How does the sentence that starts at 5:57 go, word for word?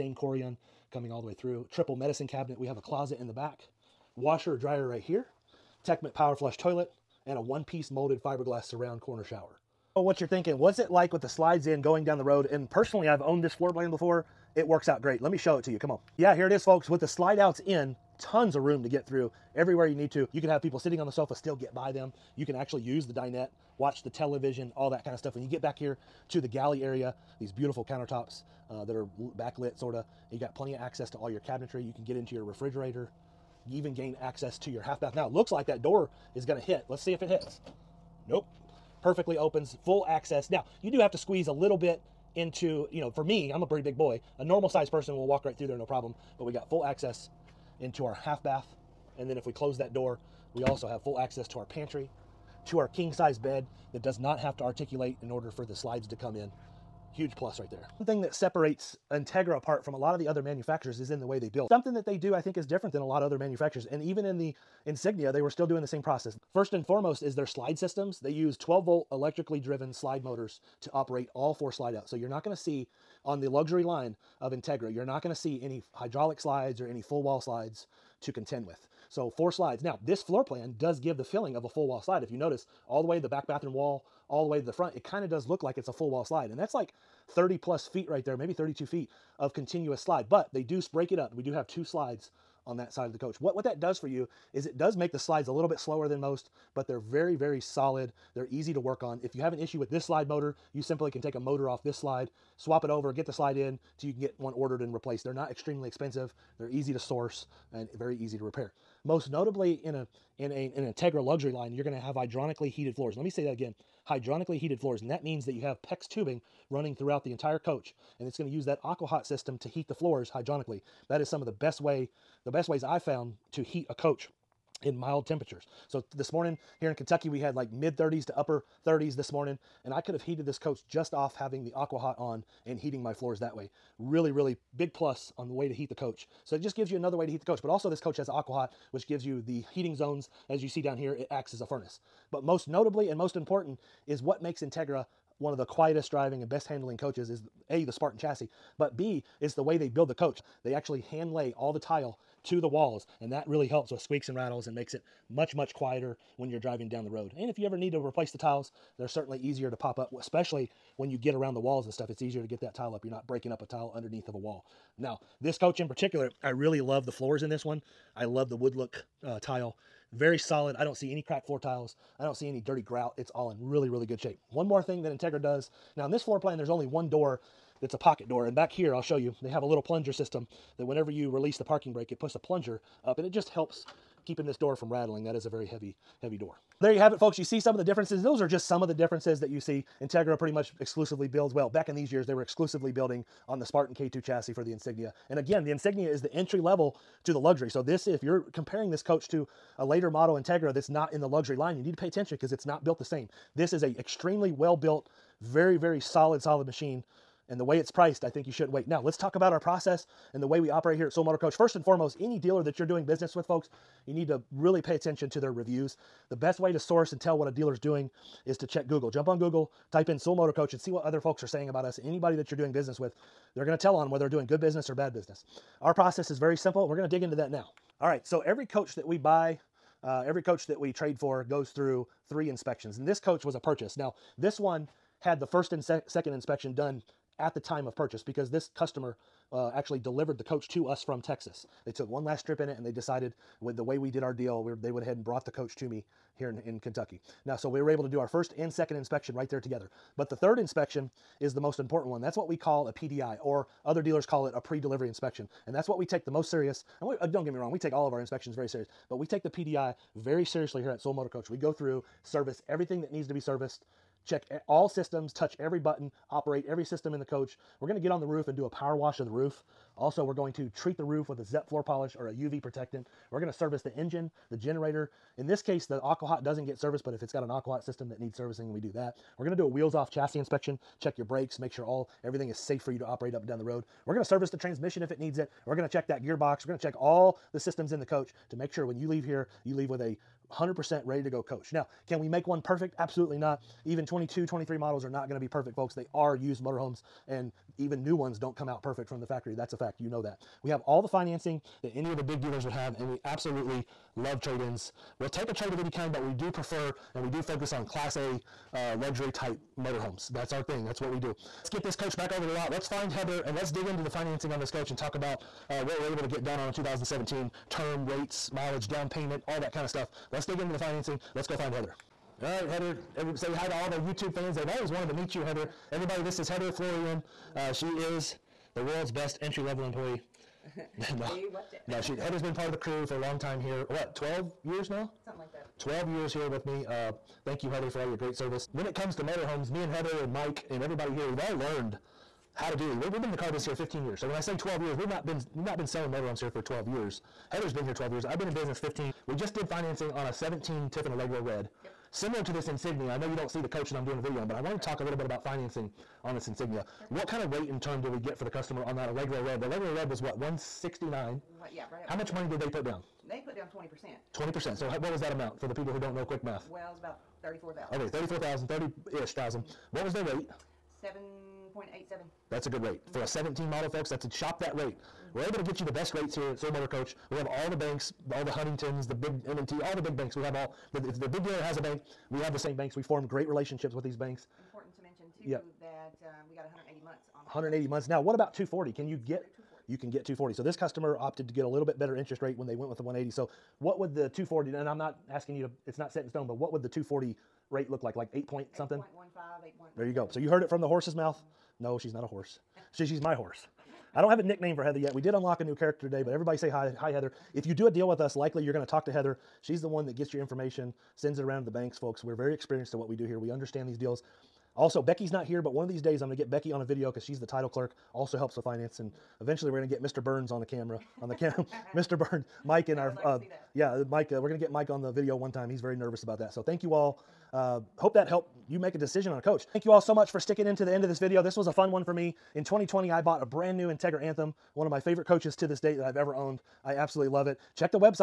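What kind of rate and term did we get for the customer on that Allegro Red?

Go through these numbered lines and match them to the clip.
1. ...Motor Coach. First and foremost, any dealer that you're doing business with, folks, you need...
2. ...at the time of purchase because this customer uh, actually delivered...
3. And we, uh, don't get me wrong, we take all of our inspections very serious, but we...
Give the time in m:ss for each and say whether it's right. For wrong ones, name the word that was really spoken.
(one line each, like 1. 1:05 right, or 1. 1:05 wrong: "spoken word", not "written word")
1. 3:31 right
2. 3:57 right
3. 4:17 right.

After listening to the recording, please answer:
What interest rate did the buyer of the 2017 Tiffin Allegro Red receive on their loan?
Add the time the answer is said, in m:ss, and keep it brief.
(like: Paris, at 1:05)
7.87%, at 6:11.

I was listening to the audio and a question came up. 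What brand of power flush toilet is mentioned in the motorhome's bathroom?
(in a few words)
Tecma.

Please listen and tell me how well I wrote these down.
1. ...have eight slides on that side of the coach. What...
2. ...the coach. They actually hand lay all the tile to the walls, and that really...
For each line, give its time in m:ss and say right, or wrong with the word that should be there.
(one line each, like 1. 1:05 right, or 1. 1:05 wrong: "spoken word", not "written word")
1. 1:31 wrong: "two", not "eight"
2. 2:30 right.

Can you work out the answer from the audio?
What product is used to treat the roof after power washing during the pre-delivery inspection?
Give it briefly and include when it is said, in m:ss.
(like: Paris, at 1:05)
ZEP floor polish, at 4:31.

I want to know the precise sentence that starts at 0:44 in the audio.
A normal sized person will walk right through there, no problem.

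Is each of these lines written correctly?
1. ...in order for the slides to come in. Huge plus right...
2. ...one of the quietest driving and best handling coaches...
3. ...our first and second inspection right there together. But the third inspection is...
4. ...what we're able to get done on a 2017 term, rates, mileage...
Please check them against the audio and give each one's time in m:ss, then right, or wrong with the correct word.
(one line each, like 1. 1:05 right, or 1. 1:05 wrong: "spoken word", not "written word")
1. 0:55 right
2. 2:25 right
3. 4:08 right
4. 5:15 right.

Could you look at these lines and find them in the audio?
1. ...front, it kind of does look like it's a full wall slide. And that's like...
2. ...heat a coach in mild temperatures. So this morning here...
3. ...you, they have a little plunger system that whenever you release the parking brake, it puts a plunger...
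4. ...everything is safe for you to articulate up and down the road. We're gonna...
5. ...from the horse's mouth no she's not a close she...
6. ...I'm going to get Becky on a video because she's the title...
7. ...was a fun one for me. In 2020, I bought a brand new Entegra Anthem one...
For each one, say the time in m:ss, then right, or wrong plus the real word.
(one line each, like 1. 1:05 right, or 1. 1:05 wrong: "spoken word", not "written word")
1. 1:24 right
2. 2:03 right
3. 2:59 right
4. 4:42 wrong: "operate", not "articulate"
5. 6:40 wrong: "horse", not "close"
6. 6:56 right
7. 7:11 right.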